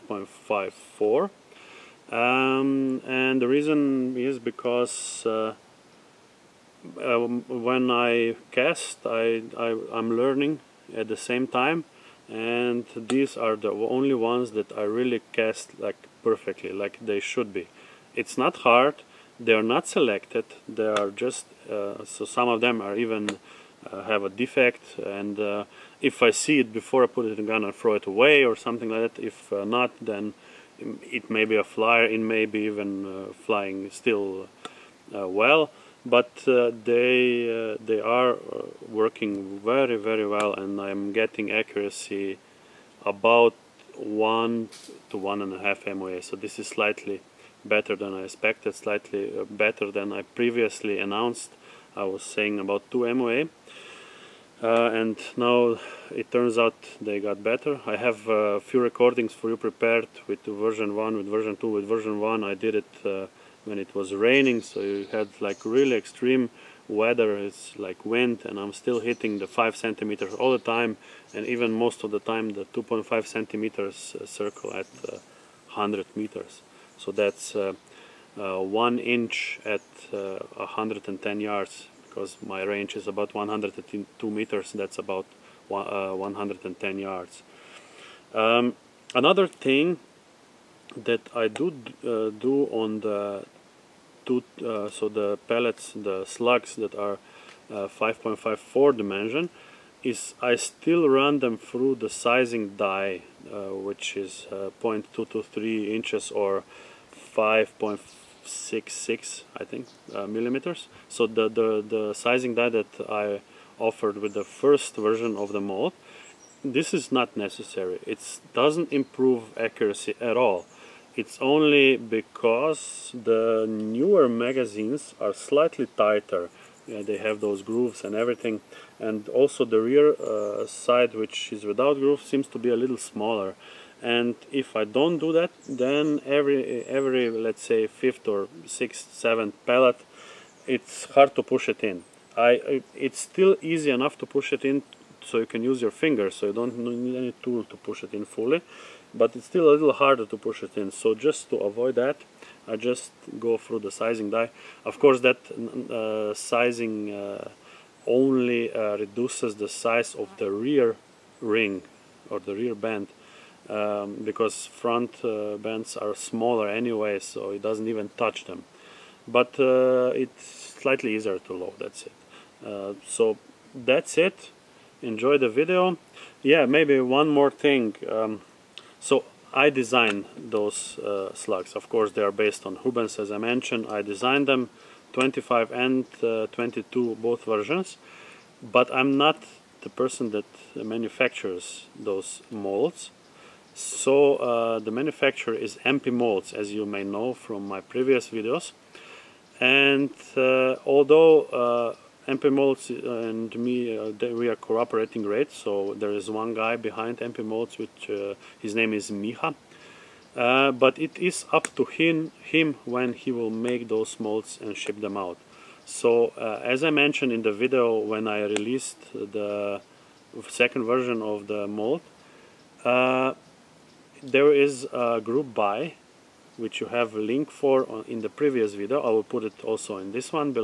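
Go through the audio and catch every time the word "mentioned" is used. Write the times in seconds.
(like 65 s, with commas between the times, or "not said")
183 s, 216 s.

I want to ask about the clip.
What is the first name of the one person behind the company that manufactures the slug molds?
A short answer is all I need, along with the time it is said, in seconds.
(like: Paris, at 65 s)
Miha, at 209 s.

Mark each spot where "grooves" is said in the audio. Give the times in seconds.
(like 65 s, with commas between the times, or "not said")
127 s, 131 s.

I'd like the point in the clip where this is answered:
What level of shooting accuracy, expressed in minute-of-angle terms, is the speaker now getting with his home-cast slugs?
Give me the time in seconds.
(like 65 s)
43 s.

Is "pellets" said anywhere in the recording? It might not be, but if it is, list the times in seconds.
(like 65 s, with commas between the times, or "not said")
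95 s, 139 s.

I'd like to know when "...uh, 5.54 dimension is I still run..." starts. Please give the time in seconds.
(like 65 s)
97 s.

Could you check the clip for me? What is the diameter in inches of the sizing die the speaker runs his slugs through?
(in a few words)
0.223 inches.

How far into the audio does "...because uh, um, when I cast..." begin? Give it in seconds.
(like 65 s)
4 s.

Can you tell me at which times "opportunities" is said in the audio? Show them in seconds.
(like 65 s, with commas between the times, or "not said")
not said.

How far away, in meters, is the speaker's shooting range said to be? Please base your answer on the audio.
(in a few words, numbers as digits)
102 meters.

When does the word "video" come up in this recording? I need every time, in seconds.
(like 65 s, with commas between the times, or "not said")
175 s, 198 s, 217 s, 228 s.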